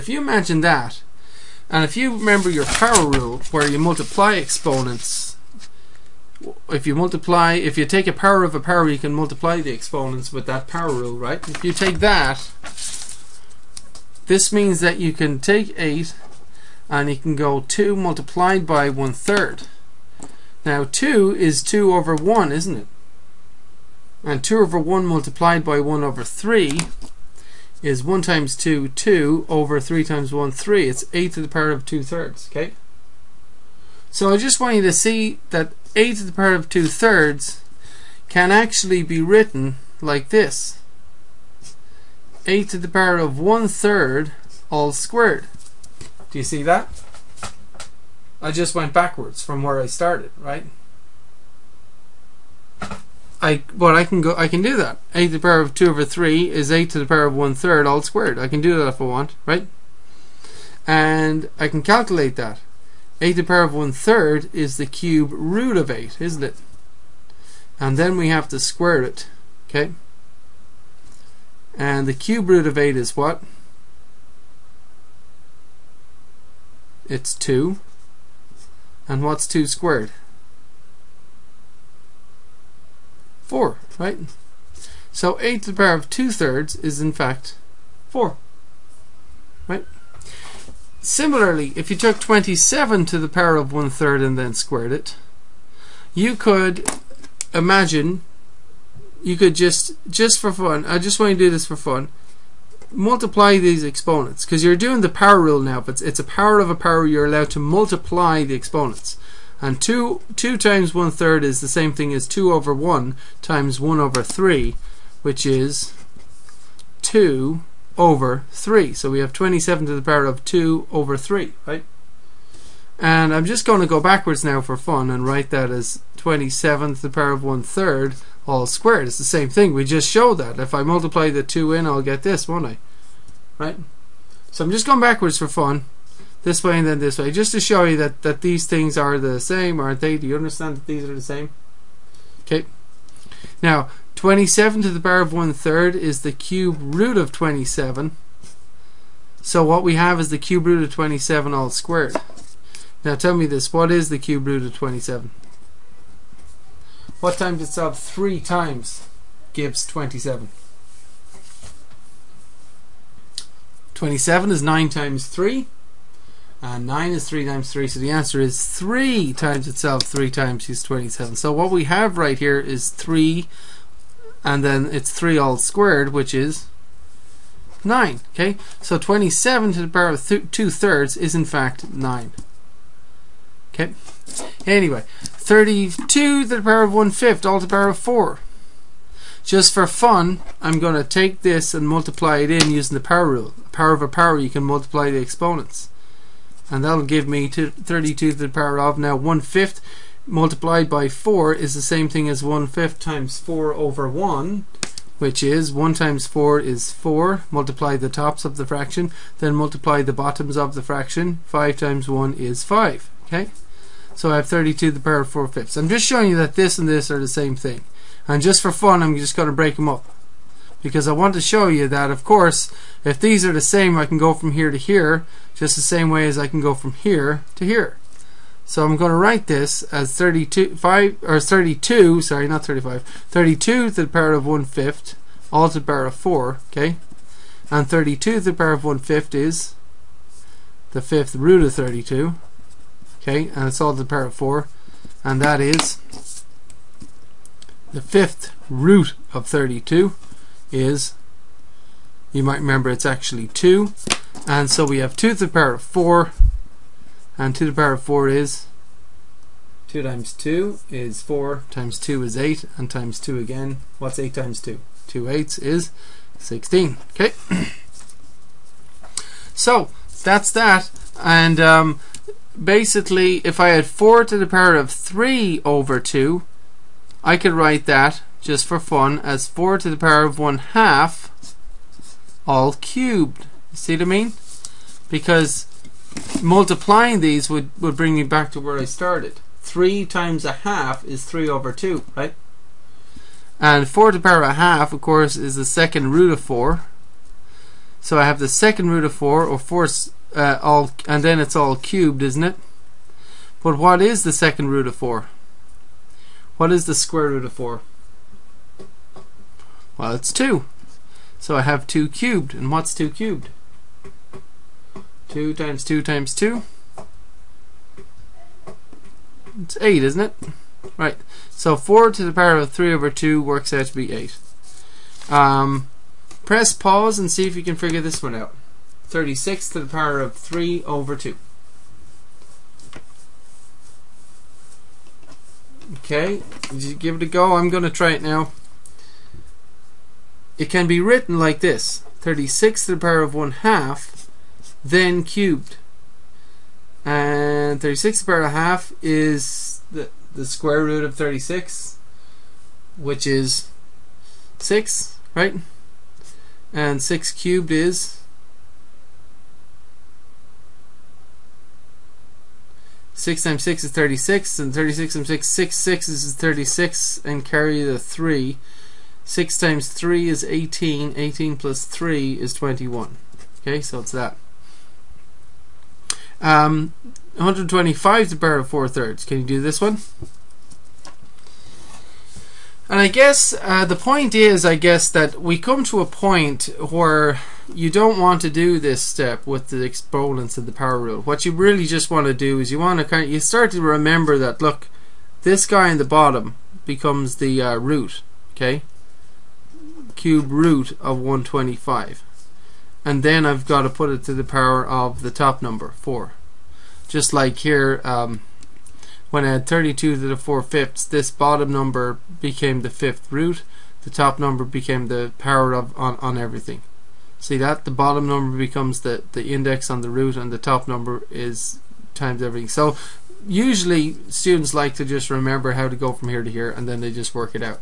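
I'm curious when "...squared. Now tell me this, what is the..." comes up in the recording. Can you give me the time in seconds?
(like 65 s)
151 s.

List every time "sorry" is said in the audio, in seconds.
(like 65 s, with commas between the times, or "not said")
232 s.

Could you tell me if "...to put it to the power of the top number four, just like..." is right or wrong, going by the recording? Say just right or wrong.
right.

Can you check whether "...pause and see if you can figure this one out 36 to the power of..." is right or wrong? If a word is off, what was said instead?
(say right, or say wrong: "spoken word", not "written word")
right.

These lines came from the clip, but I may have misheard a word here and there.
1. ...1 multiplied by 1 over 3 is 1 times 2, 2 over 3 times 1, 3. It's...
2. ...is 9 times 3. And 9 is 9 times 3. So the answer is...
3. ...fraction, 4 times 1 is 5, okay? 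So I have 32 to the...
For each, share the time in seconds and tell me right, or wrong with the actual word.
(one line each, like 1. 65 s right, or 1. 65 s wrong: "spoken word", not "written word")
1. 24 s right
2. 164 s wrong: "3", not "9"
3. 210 s wrong: "5", not "4".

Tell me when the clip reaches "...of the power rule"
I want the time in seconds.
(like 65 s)
390 s.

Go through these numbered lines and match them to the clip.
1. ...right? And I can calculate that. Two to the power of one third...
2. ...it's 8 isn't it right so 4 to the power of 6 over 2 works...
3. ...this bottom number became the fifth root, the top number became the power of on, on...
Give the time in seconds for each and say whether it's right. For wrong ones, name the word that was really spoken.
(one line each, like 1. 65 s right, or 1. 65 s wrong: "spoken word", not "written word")
1. 59 s wrong: "Eight", not "Two"
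2. 319 s wrong: "3", not "6"
3. 411 s right.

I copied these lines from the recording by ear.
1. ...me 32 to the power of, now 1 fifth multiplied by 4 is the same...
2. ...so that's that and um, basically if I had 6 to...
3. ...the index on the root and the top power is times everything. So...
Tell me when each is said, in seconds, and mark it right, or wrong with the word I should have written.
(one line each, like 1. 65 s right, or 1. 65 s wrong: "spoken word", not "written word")
1. 197 s right
2. 269 s wrong: "4", not "6"
3. 419 s wrong: "number", not "power".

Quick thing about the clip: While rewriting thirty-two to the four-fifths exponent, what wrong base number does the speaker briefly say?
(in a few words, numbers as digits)
35.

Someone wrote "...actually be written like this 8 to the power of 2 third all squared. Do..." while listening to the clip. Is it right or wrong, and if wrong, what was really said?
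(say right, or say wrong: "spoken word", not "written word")
wrong: "1", not "2".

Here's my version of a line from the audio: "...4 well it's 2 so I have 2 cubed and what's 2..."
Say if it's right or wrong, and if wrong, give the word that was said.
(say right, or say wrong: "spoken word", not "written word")
right.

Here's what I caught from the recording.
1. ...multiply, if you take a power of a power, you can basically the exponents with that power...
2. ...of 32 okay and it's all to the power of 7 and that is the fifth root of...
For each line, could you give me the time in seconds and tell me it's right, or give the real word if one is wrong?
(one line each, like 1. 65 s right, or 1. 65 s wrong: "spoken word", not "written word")
1. 6 s wrong: "multiply", not "basically"
2. 241 s wrong: "4", not "7".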